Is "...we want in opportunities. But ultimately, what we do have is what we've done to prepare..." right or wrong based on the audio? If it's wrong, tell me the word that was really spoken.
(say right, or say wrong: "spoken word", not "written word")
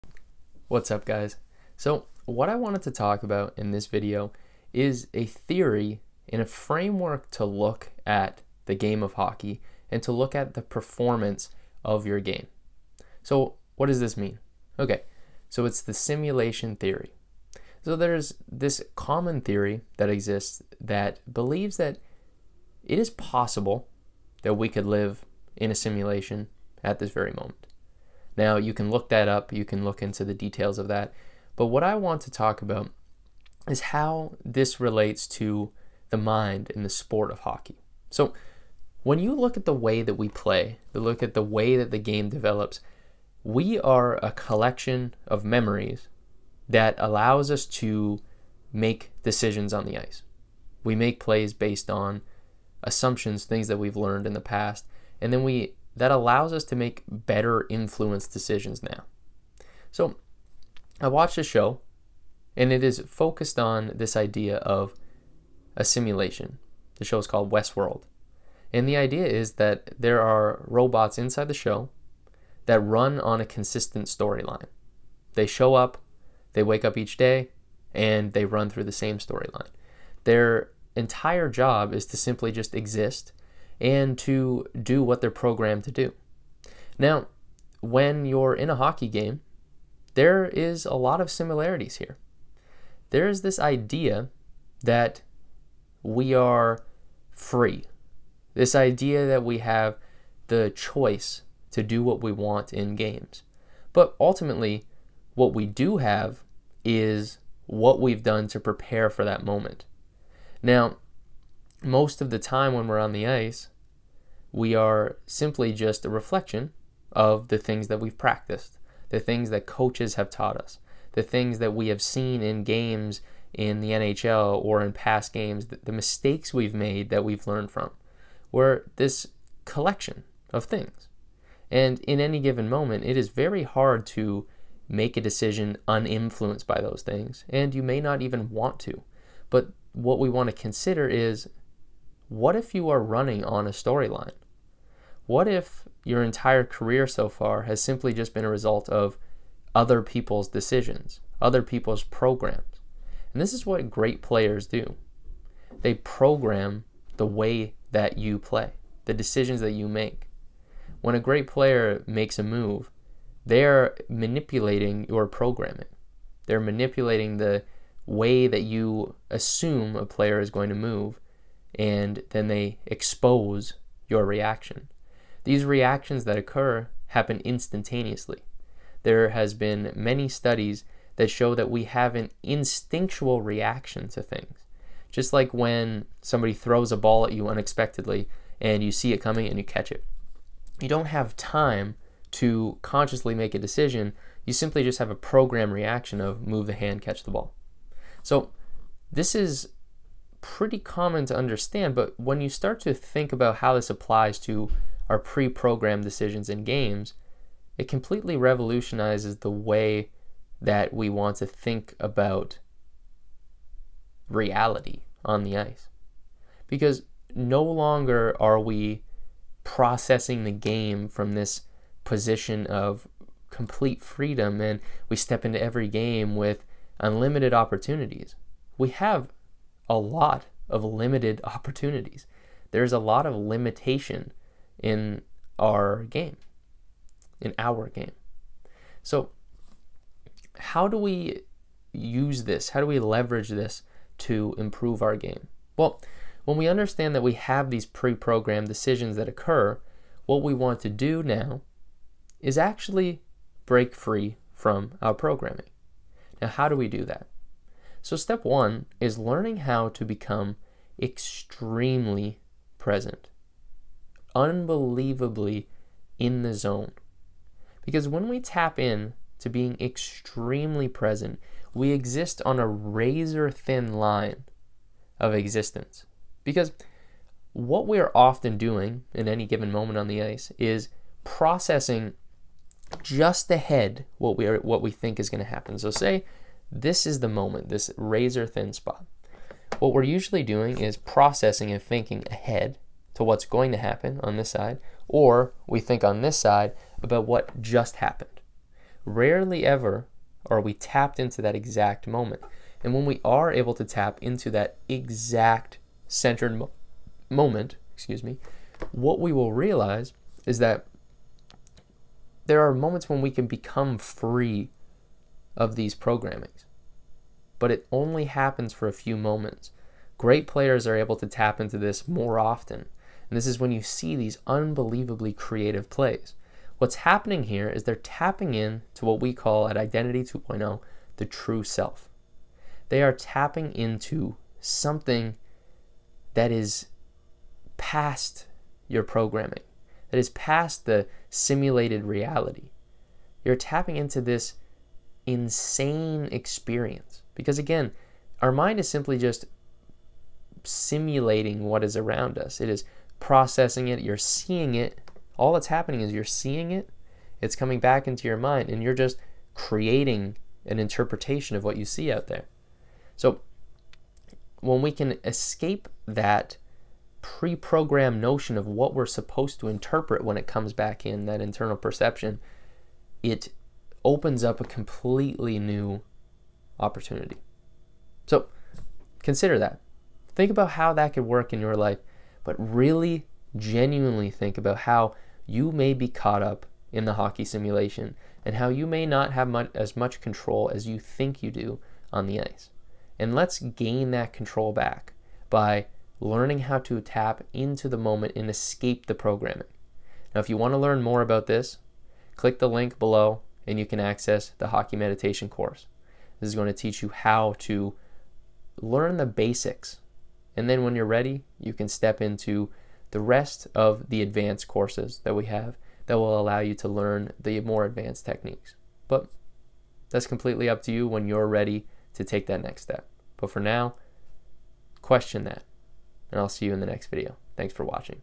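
wrong: "games", not "opportunities".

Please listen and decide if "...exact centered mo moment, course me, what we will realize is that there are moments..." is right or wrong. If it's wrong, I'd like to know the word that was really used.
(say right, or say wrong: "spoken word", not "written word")
wrong: "excuse", not "course".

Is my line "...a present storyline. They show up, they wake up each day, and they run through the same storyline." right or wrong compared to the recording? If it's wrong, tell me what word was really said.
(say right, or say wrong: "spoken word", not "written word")
wrong: "consistent", not "present".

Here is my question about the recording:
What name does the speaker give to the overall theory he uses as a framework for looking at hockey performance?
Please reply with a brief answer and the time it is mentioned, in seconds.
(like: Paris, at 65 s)
simulation theory, at 15 s.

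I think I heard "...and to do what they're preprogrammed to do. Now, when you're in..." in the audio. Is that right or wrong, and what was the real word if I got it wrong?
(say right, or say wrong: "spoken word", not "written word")
wrong: "programmed", not "preprogrammed".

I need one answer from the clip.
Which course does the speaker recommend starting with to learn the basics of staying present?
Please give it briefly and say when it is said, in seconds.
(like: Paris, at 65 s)
Hockey Meditation course, at 404 s.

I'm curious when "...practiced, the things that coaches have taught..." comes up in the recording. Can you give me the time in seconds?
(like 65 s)
118 s.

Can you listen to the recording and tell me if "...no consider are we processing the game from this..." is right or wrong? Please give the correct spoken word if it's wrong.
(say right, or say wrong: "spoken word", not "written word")
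wrong: "longer", not "consider".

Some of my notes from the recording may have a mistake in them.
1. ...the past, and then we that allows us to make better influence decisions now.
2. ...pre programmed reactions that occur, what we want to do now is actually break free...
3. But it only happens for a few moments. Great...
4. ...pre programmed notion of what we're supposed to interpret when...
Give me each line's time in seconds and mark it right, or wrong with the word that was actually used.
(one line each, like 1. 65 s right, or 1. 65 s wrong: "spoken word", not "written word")
1. 54 s right
2. 247 s wrong: "decisions", not "reactions"
3. 317 s right
4. 367 s right.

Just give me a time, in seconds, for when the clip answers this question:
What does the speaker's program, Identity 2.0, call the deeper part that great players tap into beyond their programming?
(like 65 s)
331 s.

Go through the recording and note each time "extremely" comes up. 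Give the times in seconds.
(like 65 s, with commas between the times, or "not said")
260 s, 269 s.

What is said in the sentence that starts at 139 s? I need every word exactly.
But what we want to consider is what if you are running on a storyline?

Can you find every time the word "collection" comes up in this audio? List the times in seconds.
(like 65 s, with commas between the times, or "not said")
44 s, 129 s.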